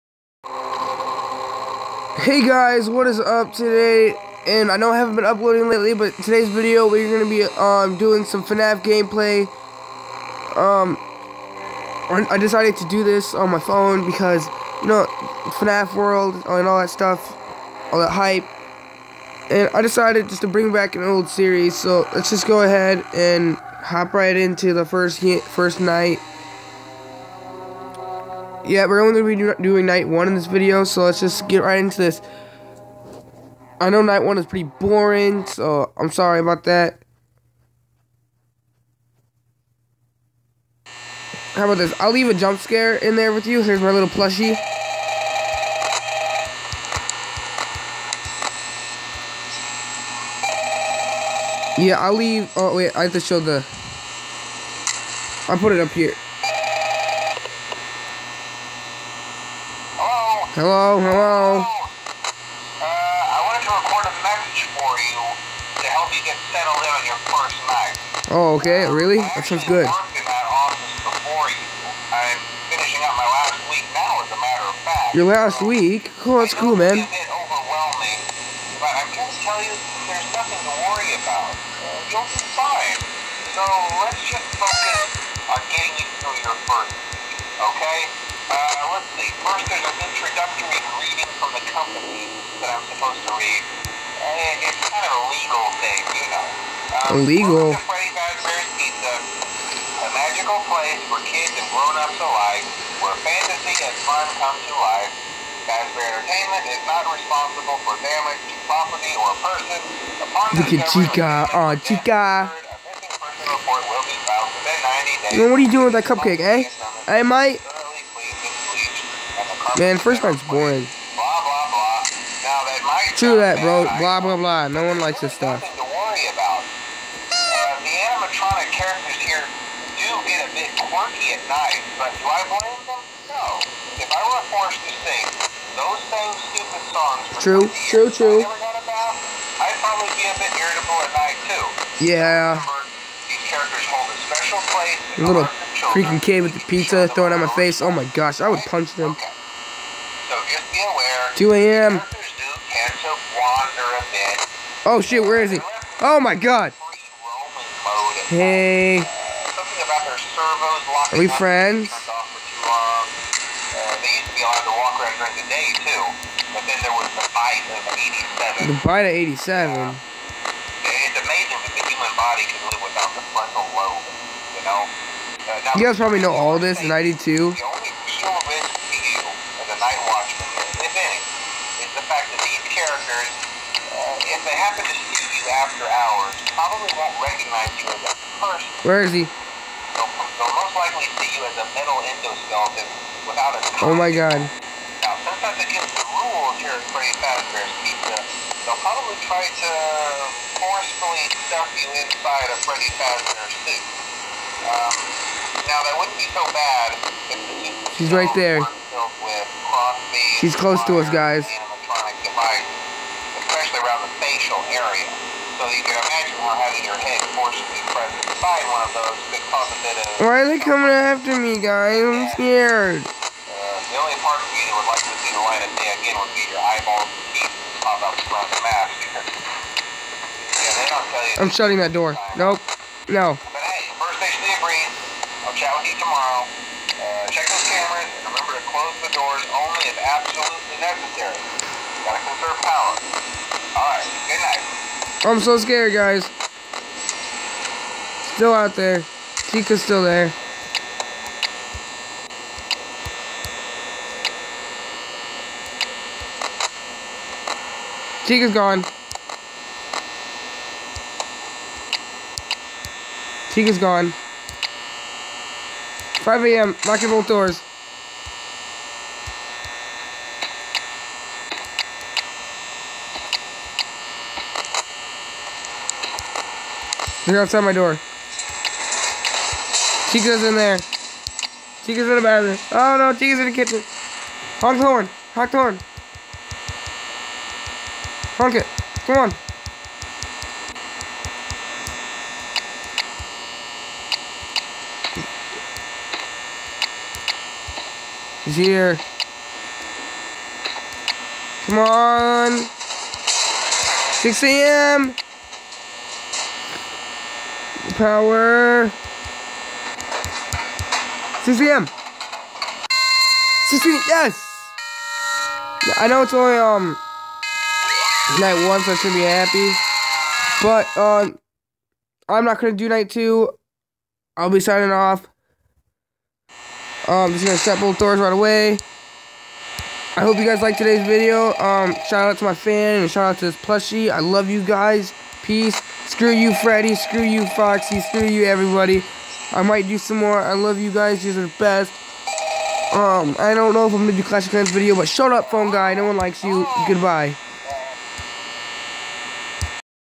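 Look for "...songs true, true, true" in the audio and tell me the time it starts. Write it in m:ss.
2:16.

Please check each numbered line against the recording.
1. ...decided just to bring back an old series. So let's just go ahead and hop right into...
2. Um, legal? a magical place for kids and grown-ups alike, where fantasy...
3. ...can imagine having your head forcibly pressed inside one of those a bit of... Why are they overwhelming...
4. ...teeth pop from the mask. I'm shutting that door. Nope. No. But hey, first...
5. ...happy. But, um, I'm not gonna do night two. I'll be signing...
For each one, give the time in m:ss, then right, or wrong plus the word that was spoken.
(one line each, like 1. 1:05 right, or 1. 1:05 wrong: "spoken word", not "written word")
1. 0:19 right
2. 1:36 right
3. 3:35 wrong: "coming", not "overwhelming"
4. 3:47 right
5. 5:19 right.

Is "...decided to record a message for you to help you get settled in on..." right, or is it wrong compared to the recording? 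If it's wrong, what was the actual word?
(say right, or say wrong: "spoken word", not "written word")
wrong: "wanted", not "decided".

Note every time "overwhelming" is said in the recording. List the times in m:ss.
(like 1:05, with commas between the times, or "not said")
1:17.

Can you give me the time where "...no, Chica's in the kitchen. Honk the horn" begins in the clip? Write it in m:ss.
4:42.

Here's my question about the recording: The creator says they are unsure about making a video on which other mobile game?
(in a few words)
Clash of Clans.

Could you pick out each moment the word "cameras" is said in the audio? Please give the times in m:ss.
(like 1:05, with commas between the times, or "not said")
3:57.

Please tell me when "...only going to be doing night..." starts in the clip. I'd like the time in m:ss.
0:29.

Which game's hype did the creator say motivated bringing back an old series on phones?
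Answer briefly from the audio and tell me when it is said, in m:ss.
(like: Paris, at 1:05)
FNAF World, at 0:15.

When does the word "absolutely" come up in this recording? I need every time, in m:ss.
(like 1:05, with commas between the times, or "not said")
4:00.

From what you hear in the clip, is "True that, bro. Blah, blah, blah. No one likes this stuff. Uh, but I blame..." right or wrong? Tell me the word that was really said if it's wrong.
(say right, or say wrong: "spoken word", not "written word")
right.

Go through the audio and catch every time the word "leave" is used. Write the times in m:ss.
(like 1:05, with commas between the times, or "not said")
0:42, 0:52.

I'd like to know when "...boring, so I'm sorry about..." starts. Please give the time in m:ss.
0:34.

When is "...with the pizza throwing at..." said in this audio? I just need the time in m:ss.
2:26.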